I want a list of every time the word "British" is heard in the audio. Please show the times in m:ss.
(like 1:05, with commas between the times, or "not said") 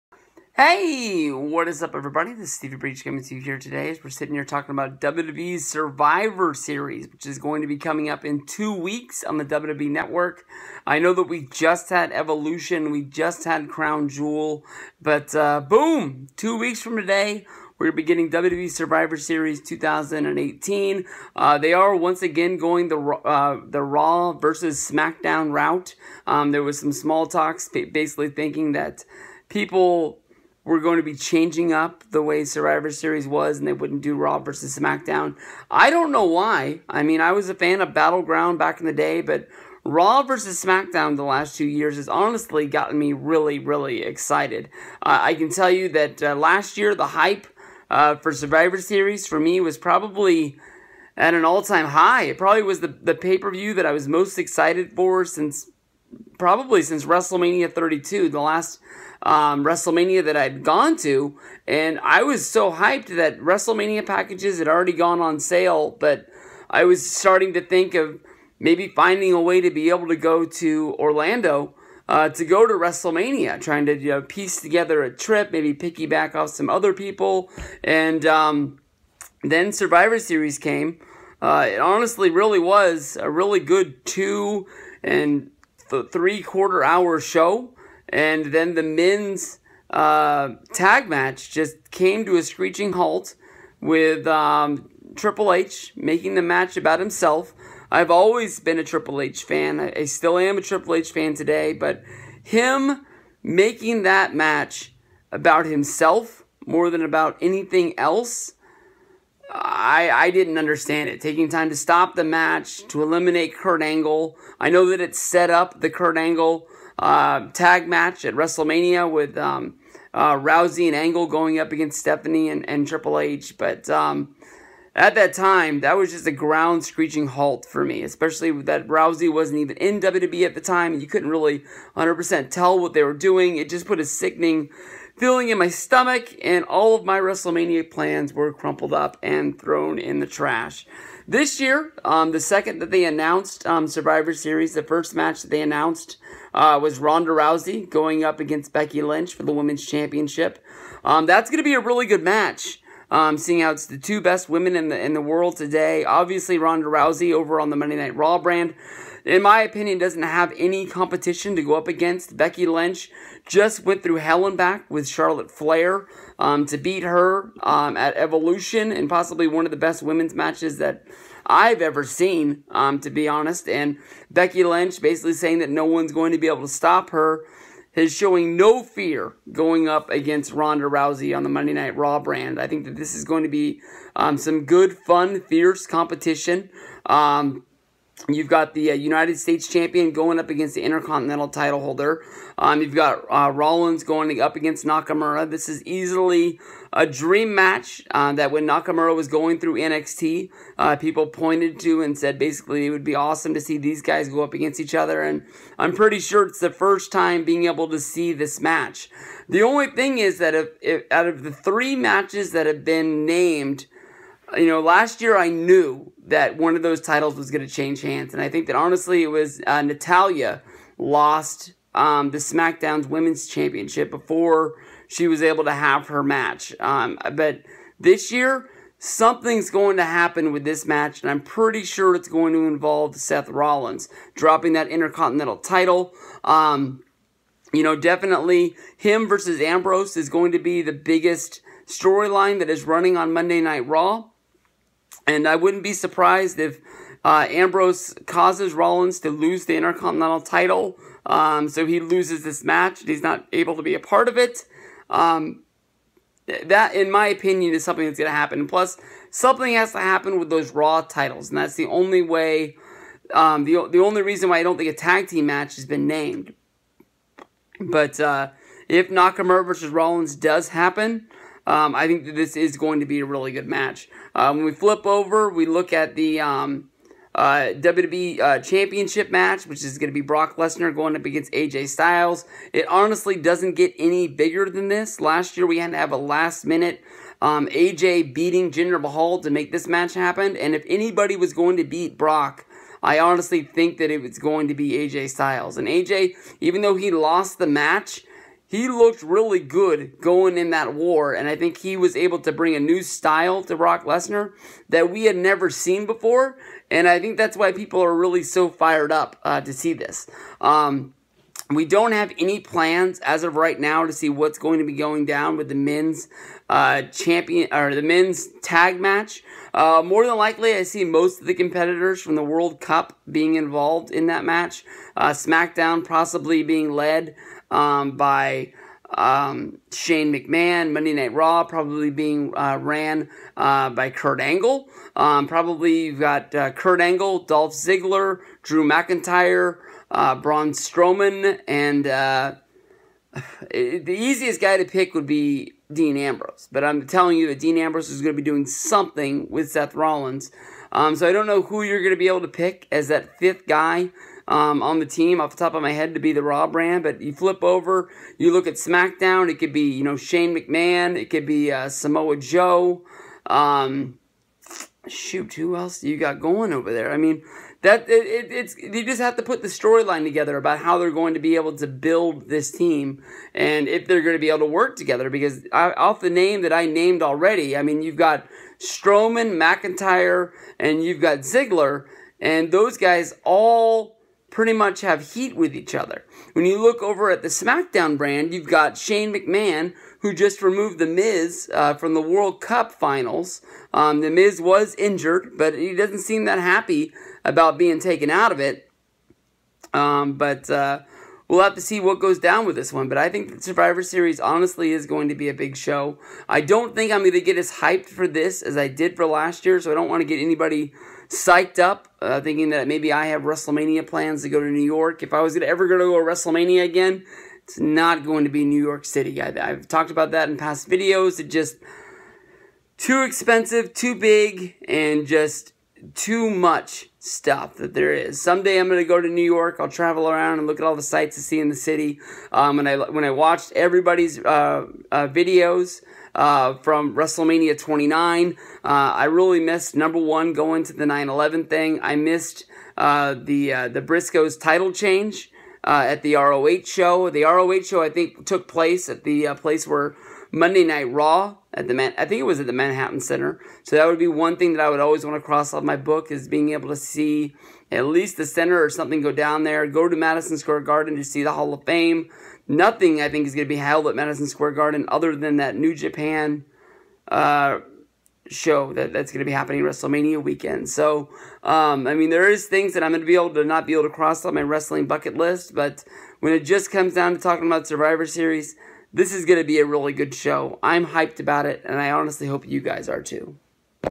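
not said.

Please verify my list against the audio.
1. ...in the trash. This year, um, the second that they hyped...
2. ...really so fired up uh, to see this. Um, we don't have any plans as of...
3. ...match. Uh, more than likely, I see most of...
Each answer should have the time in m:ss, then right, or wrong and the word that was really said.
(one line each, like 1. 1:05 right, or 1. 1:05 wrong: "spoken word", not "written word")
1. 2:19 wrong: "announced", not "hyped"
2. 5:08 right
3. 5:19 right.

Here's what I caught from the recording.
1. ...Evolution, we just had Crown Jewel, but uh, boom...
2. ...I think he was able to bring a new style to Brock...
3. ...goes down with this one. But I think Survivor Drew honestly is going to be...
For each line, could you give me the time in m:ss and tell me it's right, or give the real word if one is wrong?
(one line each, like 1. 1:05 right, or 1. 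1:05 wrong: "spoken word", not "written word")
1. 0:12 right
2. 5:01 right
3. 6:42 wrong: "Series", not "Drew".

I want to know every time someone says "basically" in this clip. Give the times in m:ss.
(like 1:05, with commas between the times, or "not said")
0:27, 2:55, 3:22.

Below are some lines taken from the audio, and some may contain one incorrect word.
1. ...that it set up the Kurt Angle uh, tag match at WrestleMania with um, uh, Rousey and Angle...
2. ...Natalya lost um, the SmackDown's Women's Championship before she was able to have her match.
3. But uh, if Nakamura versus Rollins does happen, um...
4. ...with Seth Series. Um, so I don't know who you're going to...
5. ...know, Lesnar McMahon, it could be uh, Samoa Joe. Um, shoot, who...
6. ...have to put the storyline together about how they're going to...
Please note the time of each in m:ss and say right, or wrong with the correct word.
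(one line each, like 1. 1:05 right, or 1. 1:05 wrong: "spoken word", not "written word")
1. 1:54 right
2. 3:39 right
3. 4:27 right
4. 5:49 wrong: "Rollins", not "Series"
5. 6:00 wrong: "Shane", not "Lesnar"
6. 6:09 right.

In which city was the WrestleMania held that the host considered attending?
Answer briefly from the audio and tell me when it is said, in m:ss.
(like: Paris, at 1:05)
Orlando, at 1:10.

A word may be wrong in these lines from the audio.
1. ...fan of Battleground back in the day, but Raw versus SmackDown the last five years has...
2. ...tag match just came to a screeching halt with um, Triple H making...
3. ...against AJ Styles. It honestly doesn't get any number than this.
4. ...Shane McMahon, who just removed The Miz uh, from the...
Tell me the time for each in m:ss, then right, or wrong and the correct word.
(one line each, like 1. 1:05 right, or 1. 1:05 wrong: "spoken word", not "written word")
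1. 0:37 wrong: "two", not "five"
2. 1:30 right
3. 4:41 wrong: "bigger", not "number"
4. 6:28 right.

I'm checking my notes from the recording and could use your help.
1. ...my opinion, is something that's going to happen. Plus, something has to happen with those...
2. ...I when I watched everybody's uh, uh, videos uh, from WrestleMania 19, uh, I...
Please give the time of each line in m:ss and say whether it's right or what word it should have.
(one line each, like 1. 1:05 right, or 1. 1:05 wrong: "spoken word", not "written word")
1. 4:17 right
2. 7:12 wrong: "29", not "19".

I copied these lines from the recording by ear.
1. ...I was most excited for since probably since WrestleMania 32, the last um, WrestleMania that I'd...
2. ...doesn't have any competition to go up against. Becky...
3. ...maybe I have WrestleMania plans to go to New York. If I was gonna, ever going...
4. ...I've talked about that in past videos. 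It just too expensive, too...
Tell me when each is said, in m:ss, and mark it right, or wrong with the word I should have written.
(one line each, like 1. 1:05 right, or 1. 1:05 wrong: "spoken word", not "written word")
1. 0:53 right
2. 2:39 right
3. 6:52 right
4. 6:59 right.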